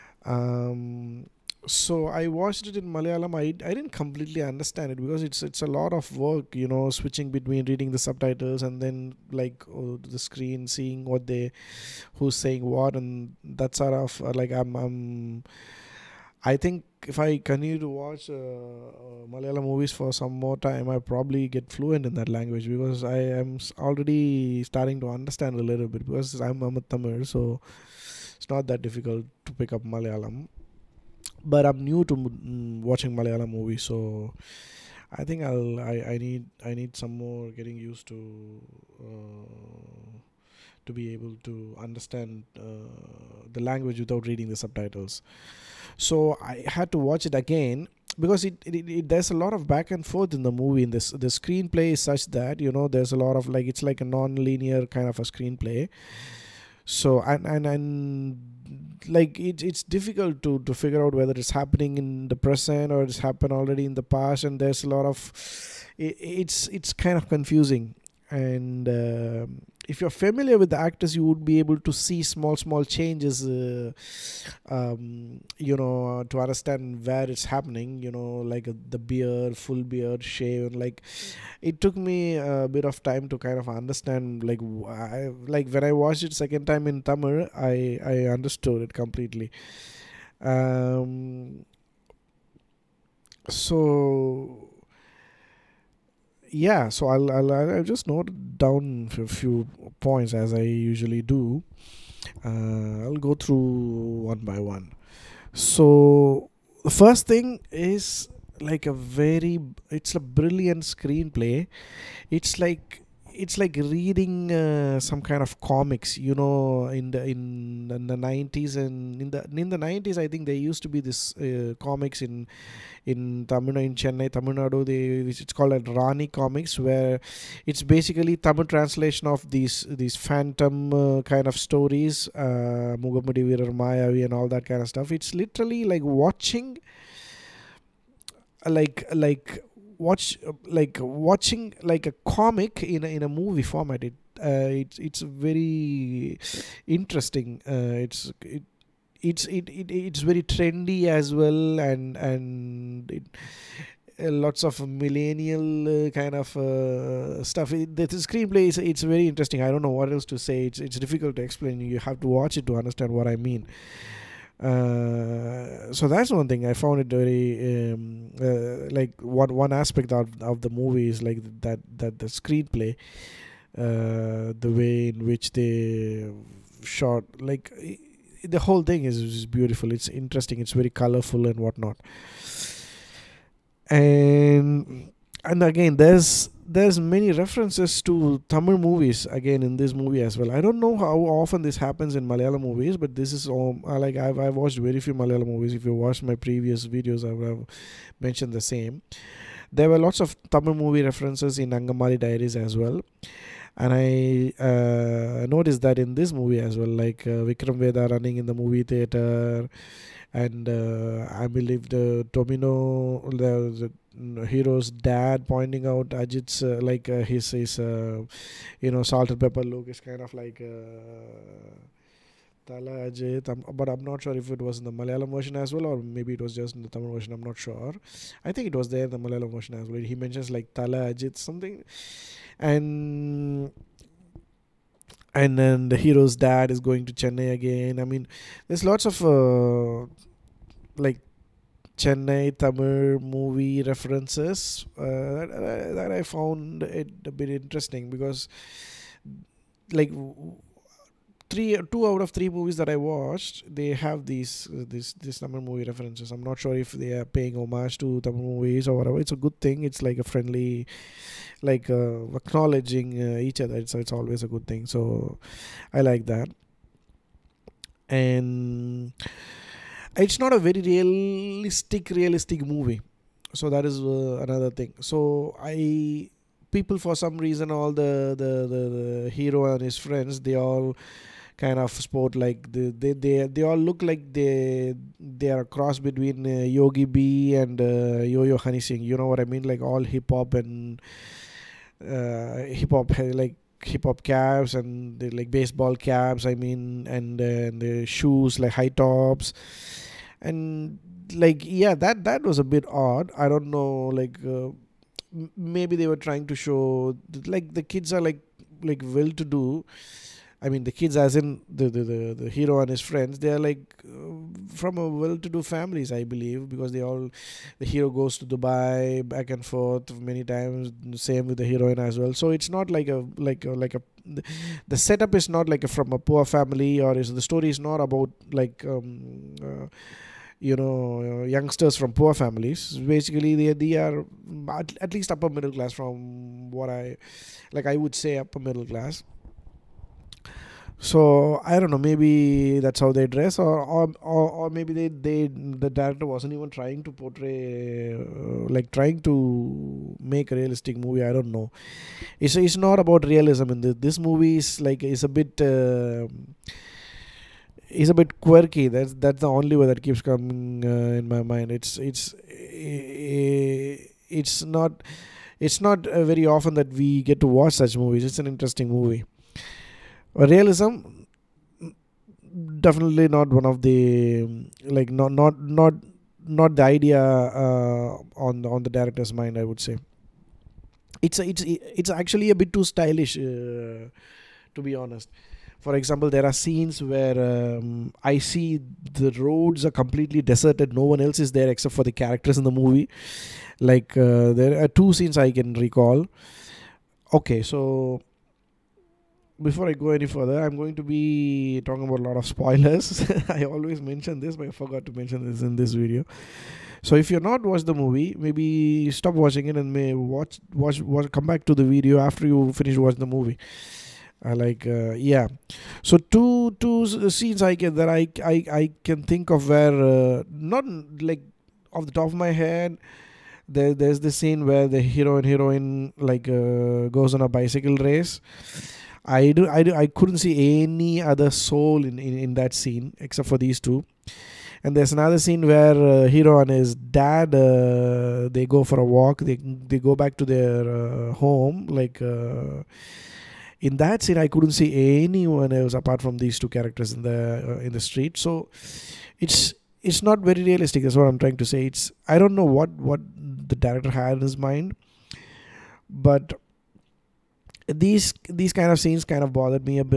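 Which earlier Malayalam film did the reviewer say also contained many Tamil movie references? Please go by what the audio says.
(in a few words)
Angamaly Diaries.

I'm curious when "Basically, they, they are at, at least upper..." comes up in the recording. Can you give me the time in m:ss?
5:32.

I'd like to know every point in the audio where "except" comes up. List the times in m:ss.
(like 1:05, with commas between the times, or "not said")
6:31, 7:13.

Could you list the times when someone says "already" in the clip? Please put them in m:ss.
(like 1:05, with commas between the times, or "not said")
0:23, 1:03.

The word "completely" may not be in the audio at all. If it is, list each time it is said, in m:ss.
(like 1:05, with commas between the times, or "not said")
0:03, 1:28, 6:30.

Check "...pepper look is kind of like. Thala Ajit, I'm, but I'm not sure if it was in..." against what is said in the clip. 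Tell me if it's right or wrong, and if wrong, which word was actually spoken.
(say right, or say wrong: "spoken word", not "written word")
right.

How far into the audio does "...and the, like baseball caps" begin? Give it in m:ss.
4:54.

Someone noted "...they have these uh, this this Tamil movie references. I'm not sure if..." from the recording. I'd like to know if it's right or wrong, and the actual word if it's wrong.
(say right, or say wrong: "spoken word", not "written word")
right.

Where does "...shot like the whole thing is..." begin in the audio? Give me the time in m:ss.
2:56.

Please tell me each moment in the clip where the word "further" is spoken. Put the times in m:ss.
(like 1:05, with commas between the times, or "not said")
6:40.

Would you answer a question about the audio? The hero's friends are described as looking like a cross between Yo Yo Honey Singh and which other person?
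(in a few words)
Yogi B.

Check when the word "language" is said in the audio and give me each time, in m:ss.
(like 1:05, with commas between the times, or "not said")
0:22, 0:43.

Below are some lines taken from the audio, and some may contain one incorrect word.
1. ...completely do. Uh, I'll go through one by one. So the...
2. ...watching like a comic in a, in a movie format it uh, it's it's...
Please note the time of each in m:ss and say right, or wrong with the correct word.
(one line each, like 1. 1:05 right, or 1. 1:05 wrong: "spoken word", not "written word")
1. 1:40 wrong: "usually", not "completely"
2. 2:21 right.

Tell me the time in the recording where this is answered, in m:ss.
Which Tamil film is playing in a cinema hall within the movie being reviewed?
3:27.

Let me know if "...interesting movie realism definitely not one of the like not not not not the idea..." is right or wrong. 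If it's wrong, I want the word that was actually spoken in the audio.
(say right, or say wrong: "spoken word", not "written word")
right.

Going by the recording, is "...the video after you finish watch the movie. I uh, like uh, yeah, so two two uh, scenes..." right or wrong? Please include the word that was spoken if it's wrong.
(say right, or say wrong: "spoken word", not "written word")
right.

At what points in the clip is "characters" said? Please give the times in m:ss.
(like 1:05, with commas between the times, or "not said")
6:32, 7:26.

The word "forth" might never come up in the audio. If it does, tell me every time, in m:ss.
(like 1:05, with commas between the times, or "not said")
0:50, 5:19.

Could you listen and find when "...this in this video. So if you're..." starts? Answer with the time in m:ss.
6:45.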